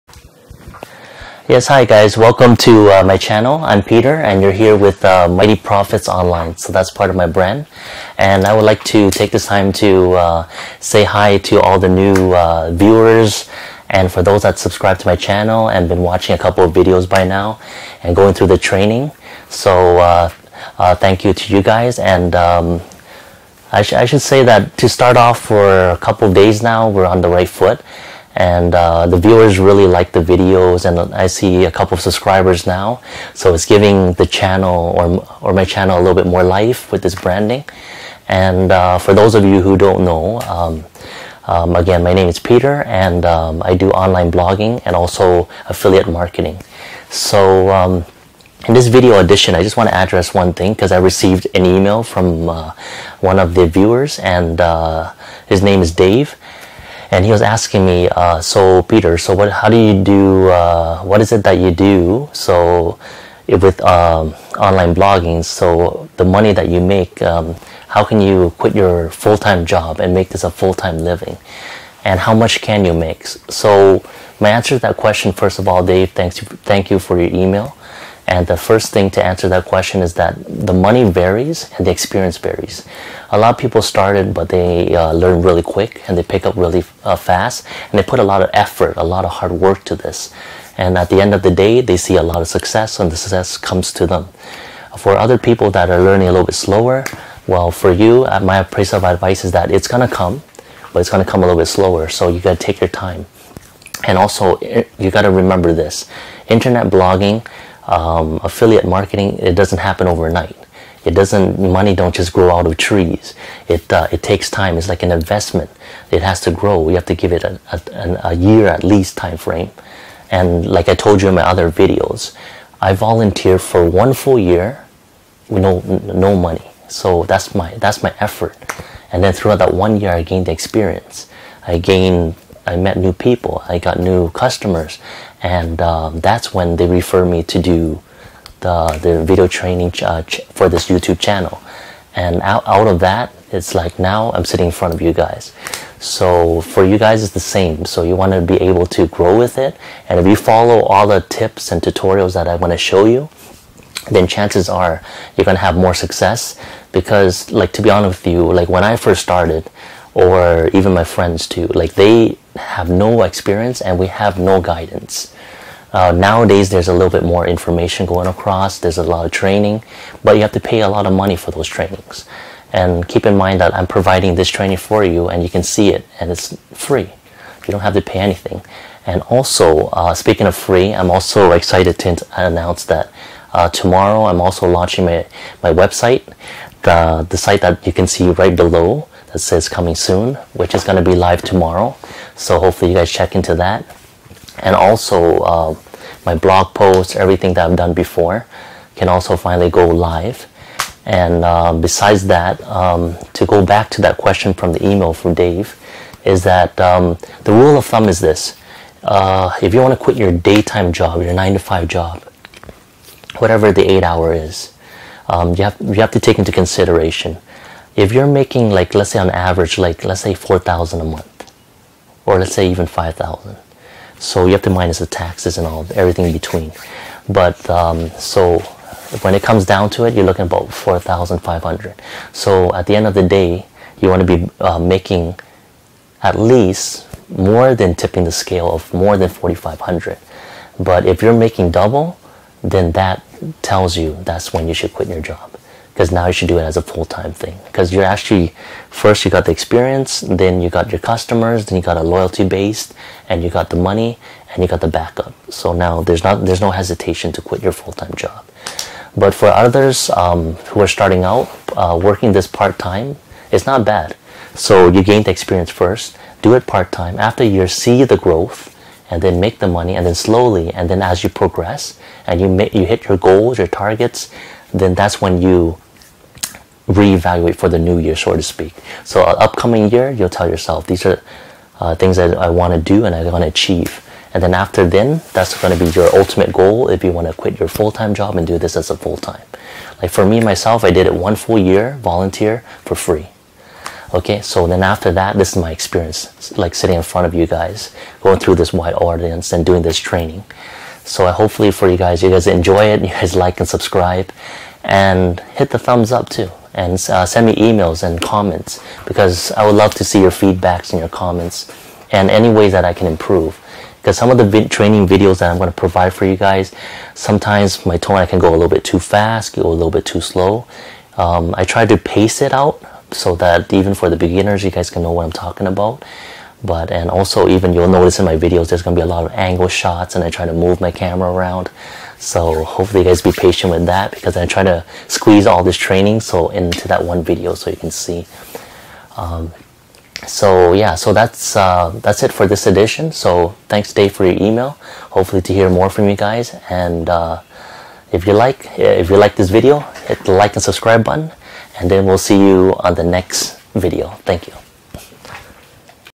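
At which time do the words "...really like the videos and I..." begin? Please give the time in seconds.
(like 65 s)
29 s.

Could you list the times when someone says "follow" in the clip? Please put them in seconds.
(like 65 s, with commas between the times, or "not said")
150 s.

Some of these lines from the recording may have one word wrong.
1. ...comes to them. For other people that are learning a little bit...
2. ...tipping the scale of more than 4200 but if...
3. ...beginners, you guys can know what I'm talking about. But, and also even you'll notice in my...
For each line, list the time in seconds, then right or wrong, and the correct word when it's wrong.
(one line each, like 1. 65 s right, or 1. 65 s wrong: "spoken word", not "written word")
1. 93 s right
2. 237 s wrong: "4500", not "4200"
3. 324 s right.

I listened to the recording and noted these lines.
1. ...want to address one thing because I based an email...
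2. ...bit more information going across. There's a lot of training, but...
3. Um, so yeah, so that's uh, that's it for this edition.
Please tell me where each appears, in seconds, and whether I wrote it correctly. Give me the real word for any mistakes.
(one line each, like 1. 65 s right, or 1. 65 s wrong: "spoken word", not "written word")
1. 49 s wrong: "received", not "based"
2. 167 s right
3. 339 s right.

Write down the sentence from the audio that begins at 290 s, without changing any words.
Like for me myself, I did it one full year, volunteer for free.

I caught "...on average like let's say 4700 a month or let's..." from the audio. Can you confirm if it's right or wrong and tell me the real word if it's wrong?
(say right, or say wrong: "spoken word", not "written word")
wrong: "4000", not "4700".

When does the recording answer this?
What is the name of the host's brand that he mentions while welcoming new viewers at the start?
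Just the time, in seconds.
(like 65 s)
5 s.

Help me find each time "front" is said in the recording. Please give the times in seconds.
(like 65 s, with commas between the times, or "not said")
144 s, 297 s.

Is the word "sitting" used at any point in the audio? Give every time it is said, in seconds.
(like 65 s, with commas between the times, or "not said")
144 s, 296 s.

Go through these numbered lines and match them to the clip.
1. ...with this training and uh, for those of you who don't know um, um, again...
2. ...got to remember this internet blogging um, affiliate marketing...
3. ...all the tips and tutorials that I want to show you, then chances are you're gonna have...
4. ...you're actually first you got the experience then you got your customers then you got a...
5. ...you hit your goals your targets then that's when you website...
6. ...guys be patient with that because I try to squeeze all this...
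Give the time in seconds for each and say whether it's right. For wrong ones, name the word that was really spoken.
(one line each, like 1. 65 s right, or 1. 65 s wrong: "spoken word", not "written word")
1. 36 s wrong: "branding", not "training"
2. 105 s right
3. 150 s right
4. 247 s right
5. 272 s wrong: "reevaluate", not "website"
6. 333 s right.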